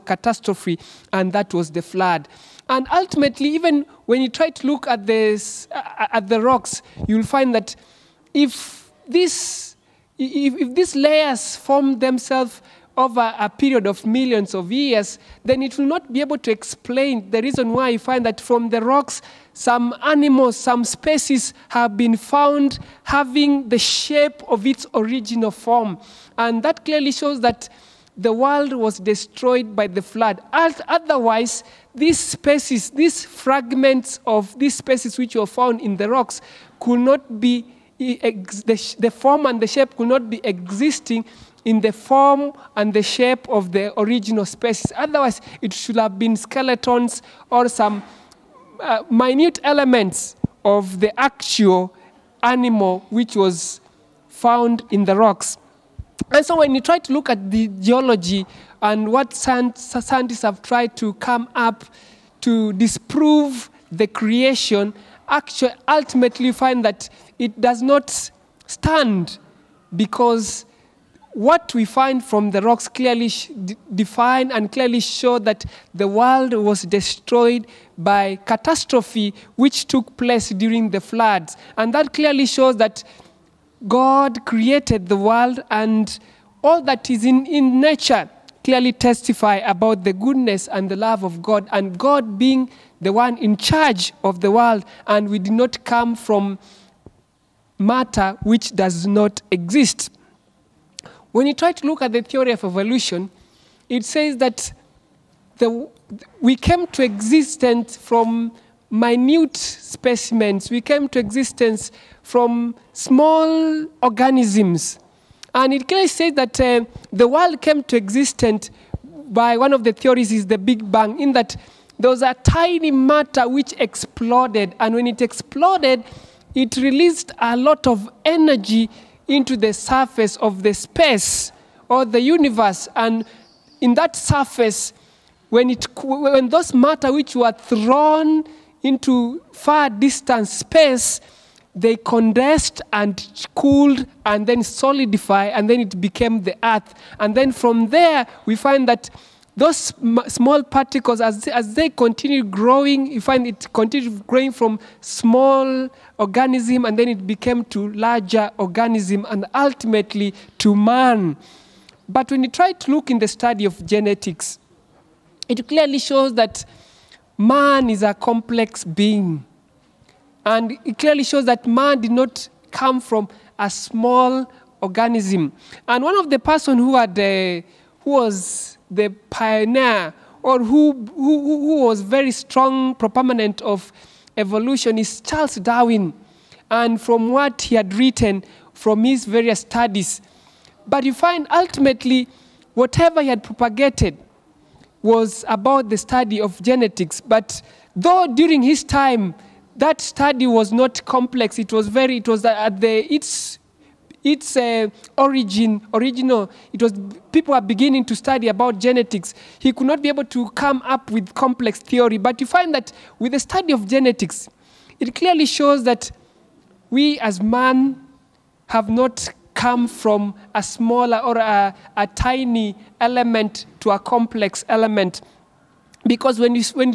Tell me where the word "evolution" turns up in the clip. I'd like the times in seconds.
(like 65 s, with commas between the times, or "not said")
102 s, 184 s.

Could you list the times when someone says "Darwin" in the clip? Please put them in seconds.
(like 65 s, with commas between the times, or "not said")
185 s.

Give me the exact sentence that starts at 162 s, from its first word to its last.
But when you try to look in the study of genetics, it clearly shows that man is a complex being.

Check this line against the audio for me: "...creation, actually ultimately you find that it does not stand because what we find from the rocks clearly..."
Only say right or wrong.
right.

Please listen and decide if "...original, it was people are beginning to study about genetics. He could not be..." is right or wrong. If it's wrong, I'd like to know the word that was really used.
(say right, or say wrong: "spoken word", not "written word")
right.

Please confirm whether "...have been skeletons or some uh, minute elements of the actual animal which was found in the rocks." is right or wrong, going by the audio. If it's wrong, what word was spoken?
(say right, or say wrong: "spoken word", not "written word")
right.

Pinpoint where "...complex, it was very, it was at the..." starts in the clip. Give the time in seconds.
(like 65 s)
201 s.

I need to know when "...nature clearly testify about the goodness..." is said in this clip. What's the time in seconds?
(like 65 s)
87 s.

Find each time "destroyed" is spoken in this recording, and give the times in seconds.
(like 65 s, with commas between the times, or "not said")
28 s, 76 s.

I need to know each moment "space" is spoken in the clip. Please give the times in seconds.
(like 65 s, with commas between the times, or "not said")
130 s, 140 s.